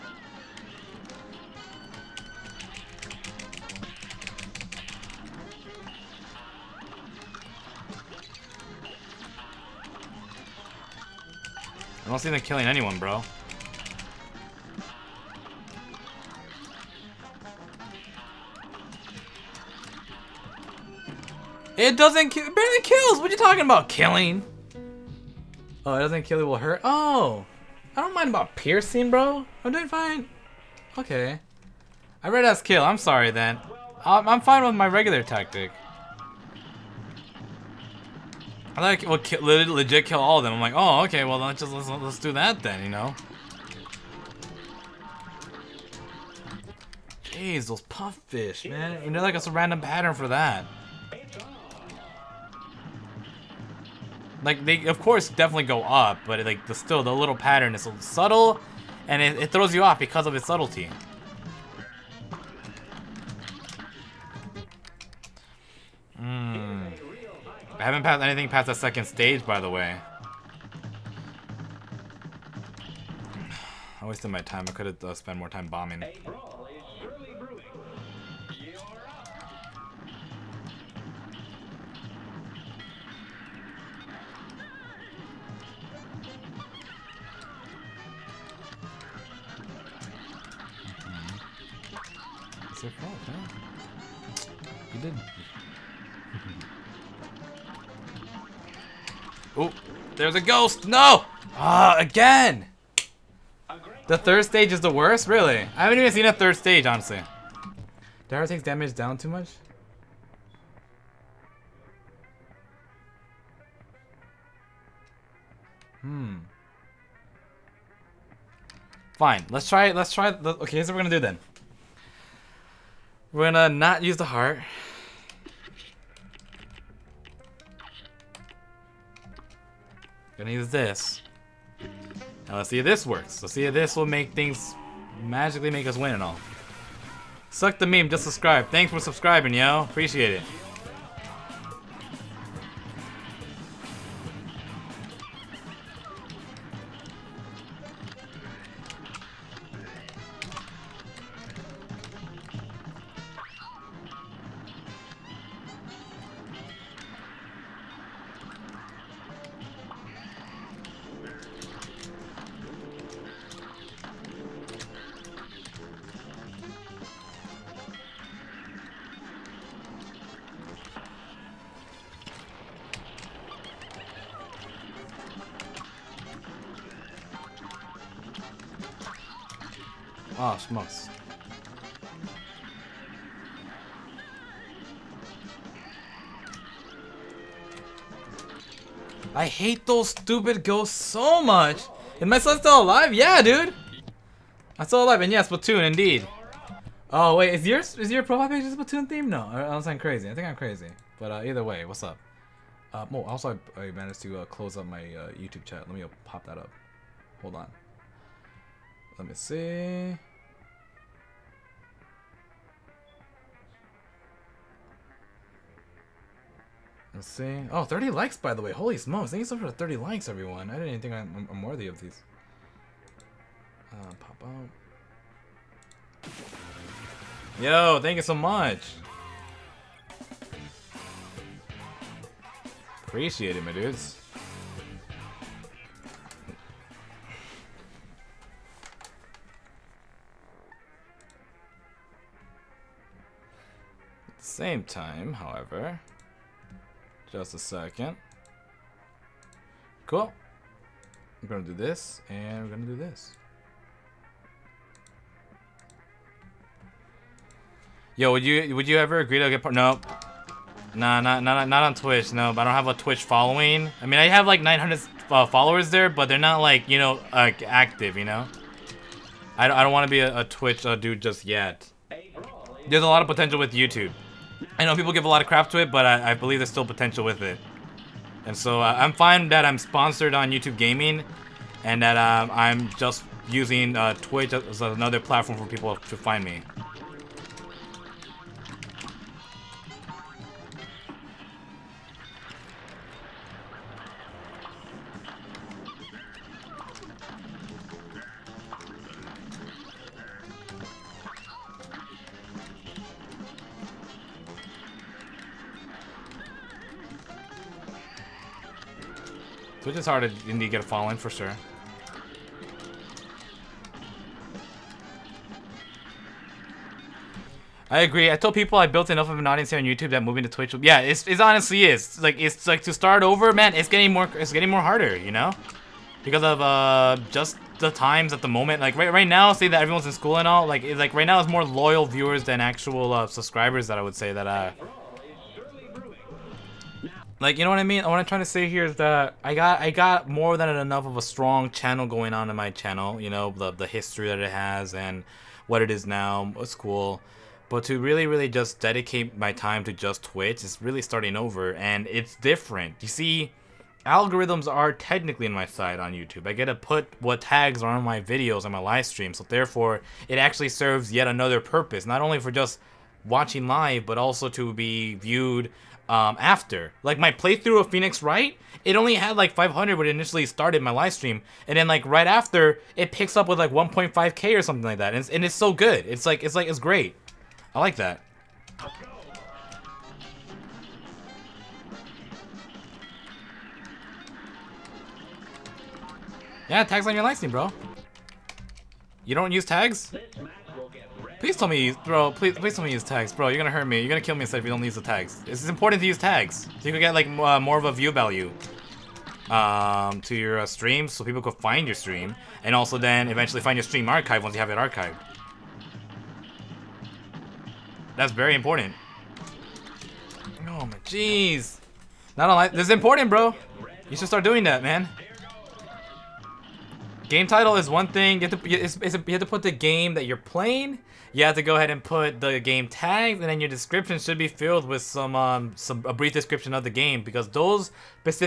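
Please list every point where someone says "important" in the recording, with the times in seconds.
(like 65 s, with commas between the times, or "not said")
395 s, 408 s, 412 s.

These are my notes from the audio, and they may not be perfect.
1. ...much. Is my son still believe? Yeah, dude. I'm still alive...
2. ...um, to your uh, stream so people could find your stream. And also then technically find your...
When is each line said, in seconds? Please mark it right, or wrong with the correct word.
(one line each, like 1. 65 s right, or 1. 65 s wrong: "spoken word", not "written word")
1. 191 s wrong: "alive", not "believe"
2. 399 s wrong: "eventually", not "technically".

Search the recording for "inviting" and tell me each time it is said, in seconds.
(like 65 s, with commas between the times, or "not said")
not said.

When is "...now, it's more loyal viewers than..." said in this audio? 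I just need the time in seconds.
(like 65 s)
331 s.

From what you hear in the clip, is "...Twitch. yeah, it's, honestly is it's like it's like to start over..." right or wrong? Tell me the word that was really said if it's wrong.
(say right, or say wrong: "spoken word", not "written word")
right.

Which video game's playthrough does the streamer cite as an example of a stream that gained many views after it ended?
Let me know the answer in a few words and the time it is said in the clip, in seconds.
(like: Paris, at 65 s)
Phoenix Wright, at 367 s.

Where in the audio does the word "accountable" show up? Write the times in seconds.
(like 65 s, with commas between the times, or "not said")
not said.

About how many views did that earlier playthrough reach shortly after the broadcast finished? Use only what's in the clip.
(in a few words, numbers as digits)
1.5k.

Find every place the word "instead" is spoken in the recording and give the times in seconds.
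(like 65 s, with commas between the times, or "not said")
394 s.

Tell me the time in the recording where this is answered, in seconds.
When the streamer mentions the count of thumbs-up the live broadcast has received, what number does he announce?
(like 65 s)
217 s.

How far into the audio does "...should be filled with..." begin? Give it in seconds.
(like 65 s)
424 s.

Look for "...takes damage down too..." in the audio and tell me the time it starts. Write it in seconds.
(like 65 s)
108 s.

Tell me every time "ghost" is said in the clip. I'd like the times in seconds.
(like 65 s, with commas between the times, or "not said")
100 s, 190 s.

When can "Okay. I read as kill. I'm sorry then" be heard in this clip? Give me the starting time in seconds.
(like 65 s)
30 s.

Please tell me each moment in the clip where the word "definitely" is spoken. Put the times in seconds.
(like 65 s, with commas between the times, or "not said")
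55 s.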